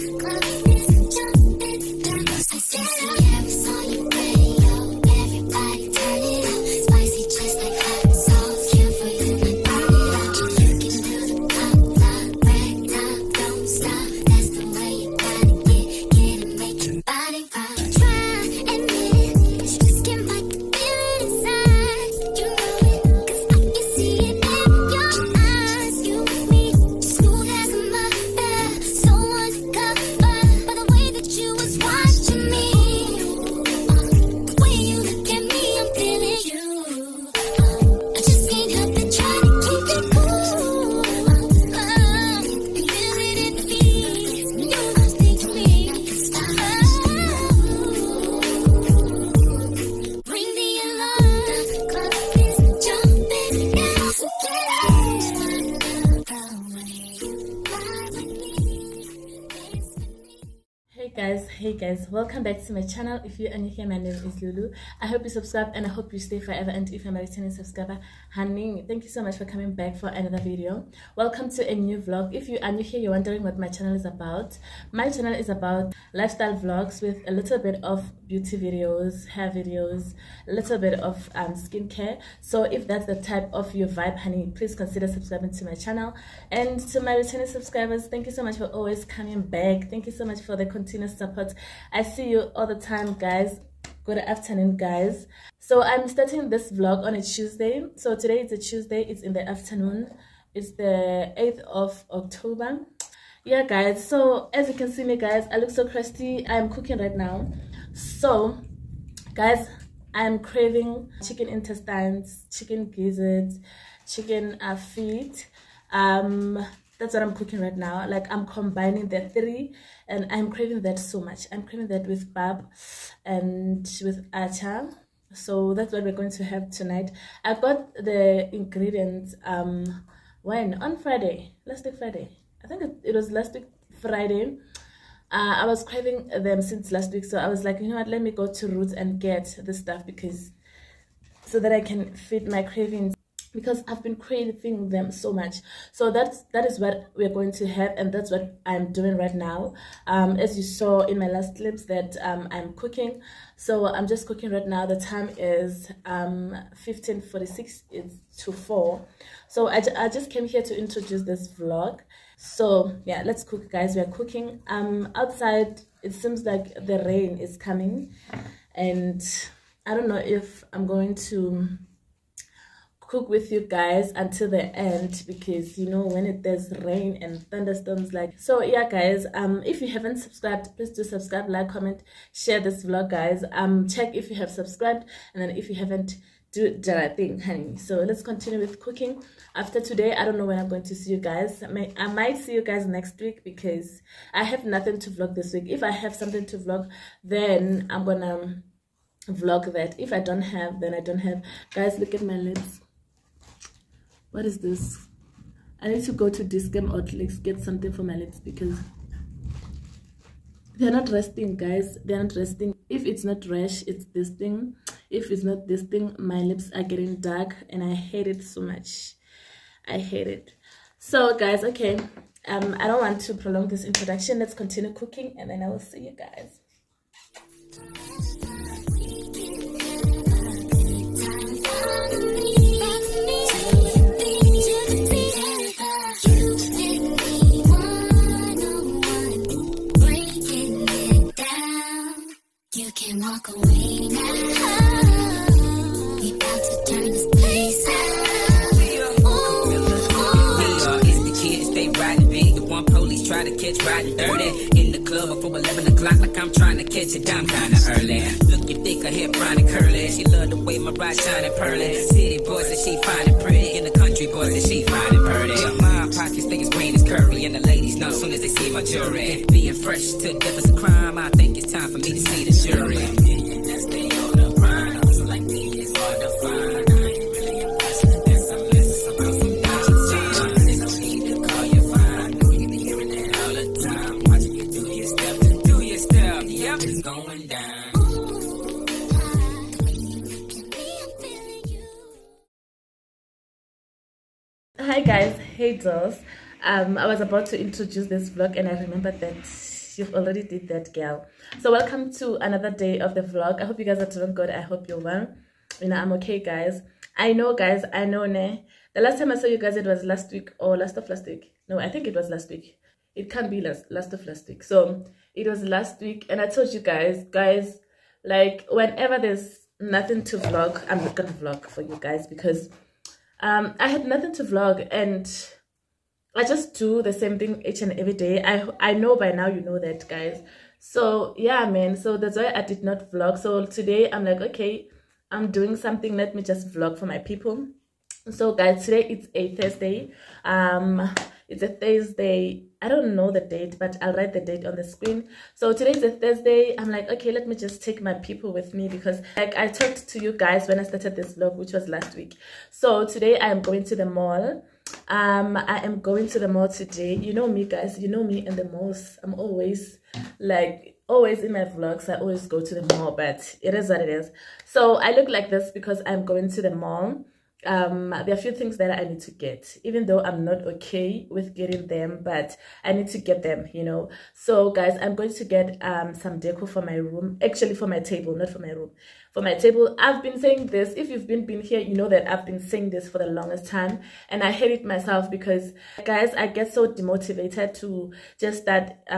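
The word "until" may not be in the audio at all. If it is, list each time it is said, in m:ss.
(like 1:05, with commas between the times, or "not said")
2:54.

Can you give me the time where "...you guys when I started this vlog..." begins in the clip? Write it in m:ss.
5:50.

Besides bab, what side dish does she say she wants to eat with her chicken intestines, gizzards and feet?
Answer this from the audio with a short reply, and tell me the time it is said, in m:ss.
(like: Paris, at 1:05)
Atchar, at 2:04.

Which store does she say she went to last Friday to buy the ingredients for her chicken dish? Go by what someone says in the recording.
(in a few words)
Roots.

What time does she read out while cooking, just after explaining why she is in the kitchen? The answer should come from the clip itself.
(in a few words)
15:46.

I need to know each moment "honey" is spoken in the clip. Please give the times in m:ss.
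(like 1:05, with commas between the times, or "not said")
1:08, 1:24, 3:07.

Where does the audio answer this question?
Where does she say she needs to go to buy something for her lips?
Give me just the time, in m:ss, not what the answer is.
3:26.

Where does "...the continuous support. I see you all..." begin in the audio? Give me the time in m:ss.
1:30.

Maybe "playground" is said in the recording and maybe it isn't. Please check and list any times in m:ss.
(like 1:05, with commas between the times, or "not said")
not said.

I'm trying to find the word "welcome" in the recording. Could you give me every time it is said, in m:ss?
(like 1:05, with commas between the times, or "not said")
1:02, 1:11, 5:01.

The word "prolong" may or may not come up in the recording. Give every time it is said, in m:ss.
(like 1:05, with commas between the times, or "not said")
3:43.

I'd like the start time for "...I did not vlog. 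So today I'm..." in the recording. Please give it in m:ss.
5:32.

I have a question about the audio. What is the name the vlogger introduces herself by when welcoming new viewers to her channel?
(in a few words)
Lulu.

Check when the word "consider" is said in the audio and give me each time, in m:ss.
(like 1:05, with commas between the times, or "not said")
1:24.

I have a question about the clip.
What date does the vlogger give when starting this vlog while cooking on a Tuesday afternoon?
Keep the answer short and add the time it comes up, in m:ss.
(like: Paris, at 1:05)
8 October, at 1:41.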